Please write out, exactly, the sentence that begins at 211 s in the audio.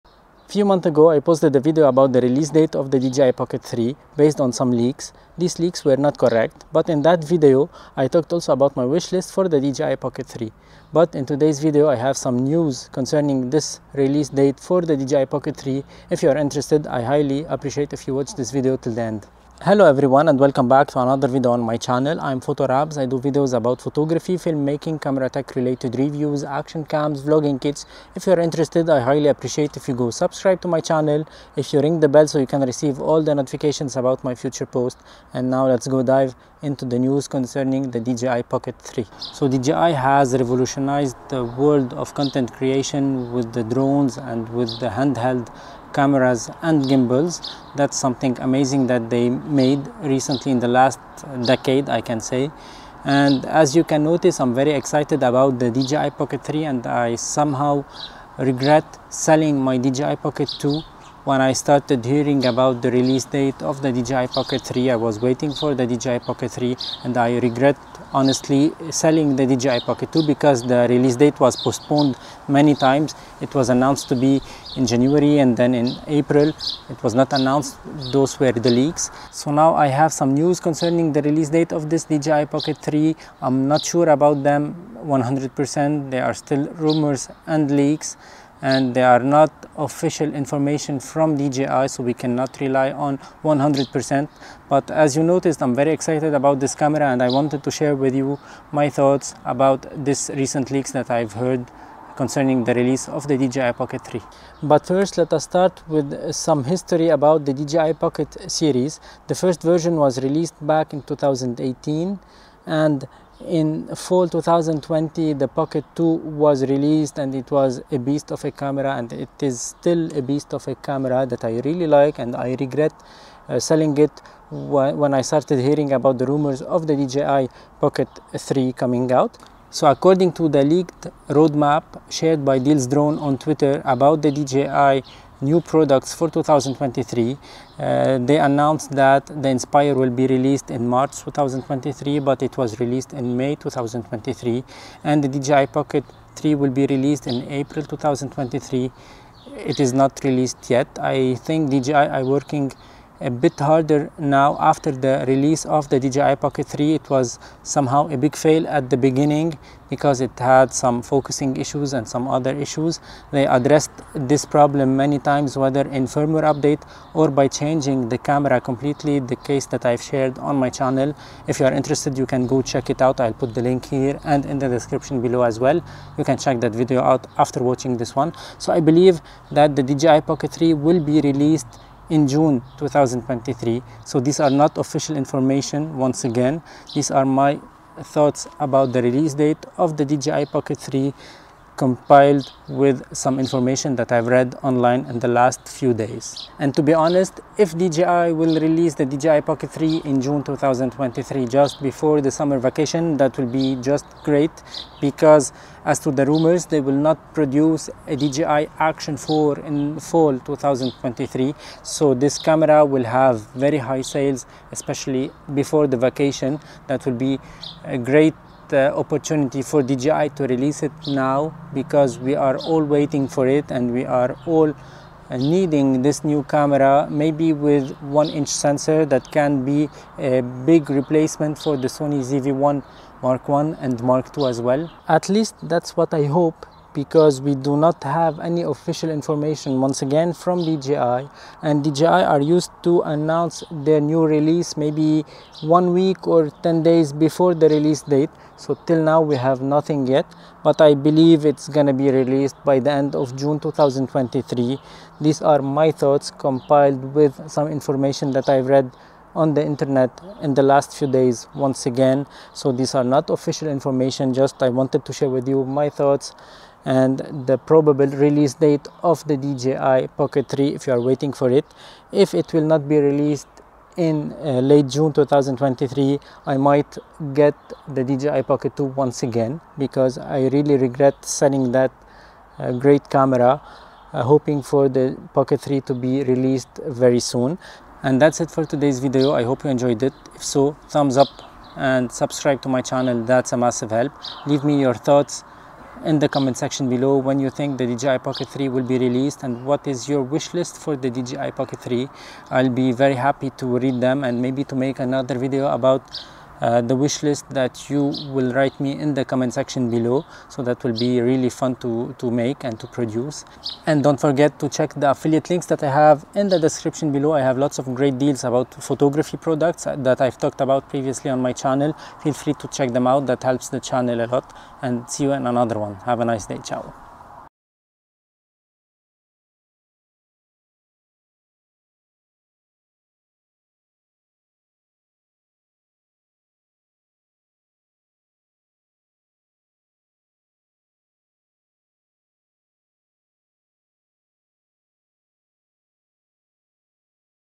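So this camera will have very high sales, especially before the vacation.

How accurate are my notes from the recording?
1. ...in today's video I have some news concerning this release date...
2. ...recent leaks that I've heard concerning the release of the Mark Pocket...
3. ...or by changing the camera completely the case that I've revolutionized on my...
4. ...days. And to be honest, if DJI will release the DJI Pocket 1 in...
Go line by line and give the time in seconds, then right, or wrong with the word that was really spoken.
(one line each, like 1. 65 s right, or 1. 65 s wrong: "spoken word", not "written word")
1. 11 s right
2. 100 s wrong: "DJI", not "Mark"
3. 167 s wrong: "shared", not "revolutionized"
4. 195 s wrong: "3", not "1".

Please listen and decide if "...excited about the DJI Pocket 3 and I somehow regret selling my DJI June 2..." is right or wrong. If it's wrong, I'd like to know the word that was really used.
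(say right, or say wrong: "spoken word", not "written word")
wrong: "Pocket", not "June".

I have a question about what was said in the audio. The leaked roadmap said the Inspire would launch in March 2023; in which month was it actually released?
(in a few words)
May.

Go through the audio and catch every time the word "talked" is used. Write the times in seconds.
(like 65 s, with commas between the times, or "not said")
8 s, 320 s.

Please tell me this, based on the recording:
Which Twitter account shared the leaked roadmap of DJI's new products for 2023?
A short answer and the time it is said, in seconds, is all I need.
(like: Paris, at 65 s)
Deals Drone, at 132 s.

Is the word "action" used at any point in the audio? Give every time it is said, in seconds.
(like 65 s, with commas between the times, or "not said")
26 s, 208 s.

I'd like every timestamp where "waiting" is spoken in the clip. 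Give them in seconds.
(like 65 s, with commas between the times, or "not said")
65 s, 222 s, 271 s.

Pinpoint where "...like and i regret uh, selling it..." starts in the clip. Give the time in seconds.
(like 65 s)
121 s.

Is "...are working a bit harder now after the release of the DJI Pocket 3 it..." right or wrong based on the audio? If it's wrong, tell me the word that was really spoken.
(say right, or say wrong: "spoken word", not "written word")
right.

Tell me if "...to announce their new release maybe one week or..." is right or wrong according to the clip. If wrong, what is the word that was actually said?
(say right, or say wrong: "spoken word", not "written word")
right.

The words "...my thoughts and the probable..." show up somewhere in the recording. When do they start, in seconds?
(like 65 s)
265 s.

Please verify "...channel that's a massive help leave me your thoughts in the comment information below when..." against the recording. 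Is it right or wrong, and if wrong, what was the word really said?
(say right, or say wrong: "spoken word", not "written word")
wrong: "section", not "information".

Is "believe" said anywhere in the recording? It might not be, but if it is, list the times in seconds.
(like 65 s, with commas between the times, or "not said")
178 s, 250 s.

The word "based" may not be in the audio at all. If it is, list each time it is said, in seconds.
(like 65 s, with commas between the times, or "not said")
4 s.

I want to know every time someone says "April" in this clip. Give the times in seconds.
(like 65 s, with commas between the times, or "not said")
76 s, 147 s.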